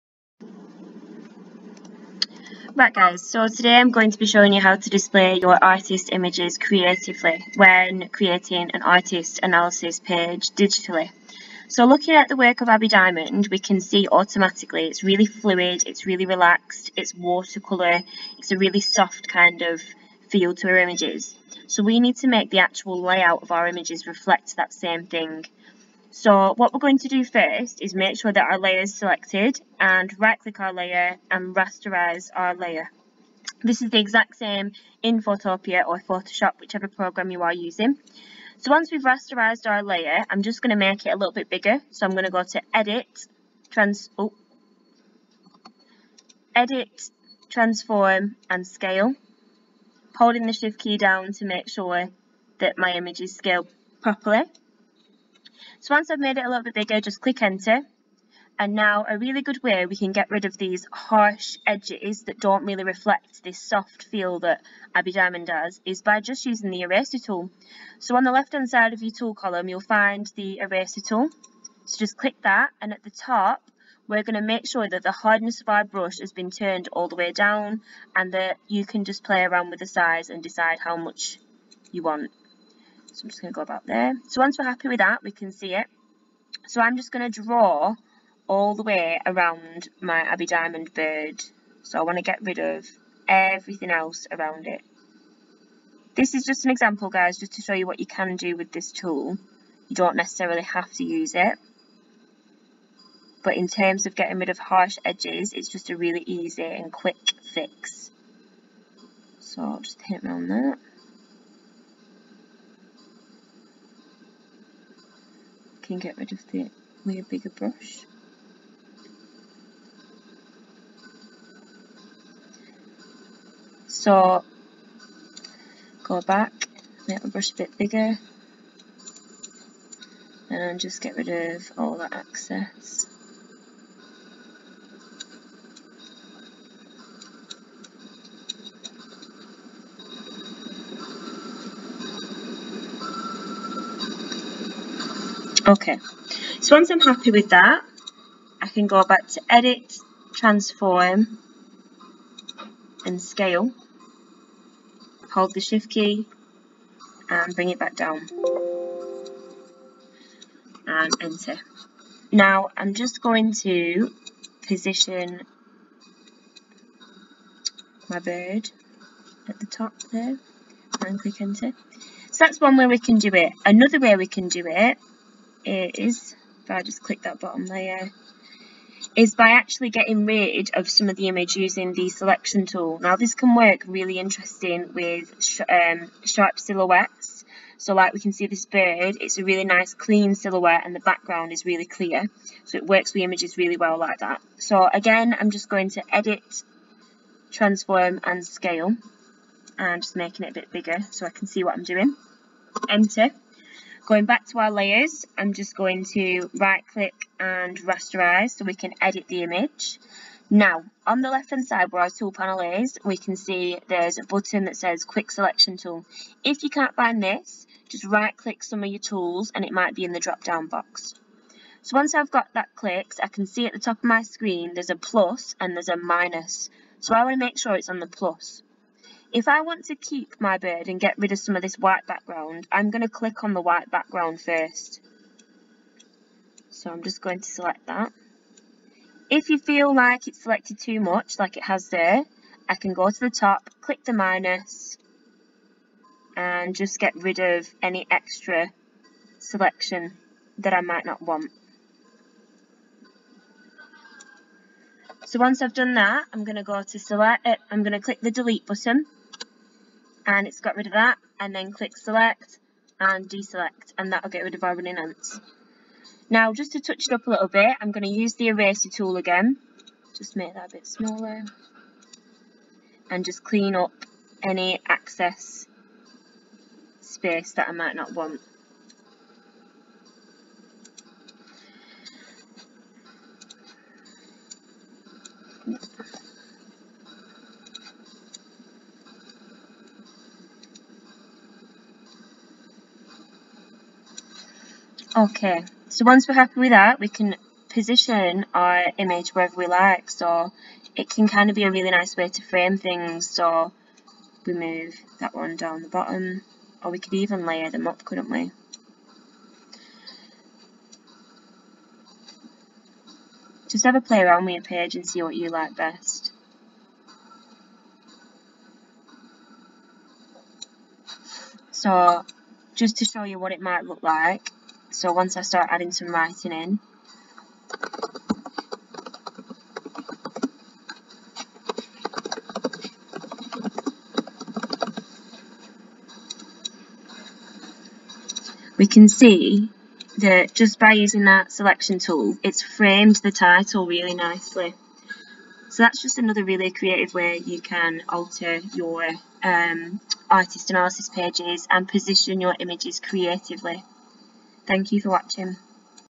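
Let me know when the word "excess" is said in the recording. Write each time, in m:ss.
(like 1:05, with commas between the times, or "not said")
2:12, 4:34.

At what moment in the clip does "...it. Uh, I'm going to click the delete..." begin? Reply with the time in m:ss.
4:17.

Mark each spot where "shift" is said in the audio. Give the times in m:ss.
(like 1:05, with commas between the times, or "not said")
0:50, 2:35.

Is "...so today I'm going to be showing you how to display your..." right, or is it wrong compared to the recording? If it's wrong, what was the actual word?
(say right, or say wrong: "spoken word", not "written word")
right.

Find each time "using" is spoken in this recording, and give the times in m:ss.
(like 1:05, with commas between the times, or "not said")
0:37, 1:06, 3:01, 5:40.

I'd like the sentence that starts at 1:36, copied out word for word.
This is just an example, guys, just to show you what you can do with this tool.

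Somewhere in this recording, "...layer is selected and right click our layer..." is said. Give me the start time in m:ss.
0:28.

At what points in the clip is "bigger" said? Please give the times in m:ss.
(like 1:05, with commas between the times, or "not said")
0:41, 0:56, 1:57, 2:07, 3:20.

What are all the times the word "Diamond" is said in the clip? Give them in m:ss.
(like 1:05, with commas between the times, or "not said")
0:12, 1:05, 1:30.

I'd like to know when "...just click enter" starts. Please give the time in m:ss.
0:57.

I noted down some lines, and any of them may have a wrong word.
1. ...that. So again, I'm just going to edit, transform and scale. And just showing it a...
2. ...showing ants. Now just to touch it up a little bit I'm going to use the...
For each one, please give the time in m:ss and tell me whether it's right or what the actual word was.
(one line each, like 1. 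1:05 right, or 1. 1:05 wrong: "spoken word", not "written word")
1. 3:14 wrong: "making", not "showing"
2. 4:24 wrong: "running", not "showing".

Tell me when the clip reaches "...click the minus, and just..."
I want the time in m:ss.
4:03.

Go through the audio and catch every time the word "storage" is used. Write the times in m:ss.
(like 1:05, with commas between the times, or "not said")
not said.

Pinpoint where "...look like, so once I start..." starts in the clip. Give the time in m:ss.
5:23.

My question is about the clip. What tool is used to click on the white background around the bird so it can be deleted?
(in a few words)
quick selection tool.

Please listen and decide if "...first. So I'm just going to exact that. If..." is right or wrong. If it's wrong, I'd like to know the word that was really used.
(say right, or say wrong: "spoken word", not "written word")
wrong: "select", not "exact".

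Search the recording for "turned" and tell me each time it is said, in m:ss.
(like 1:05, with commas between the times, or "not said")
1:16.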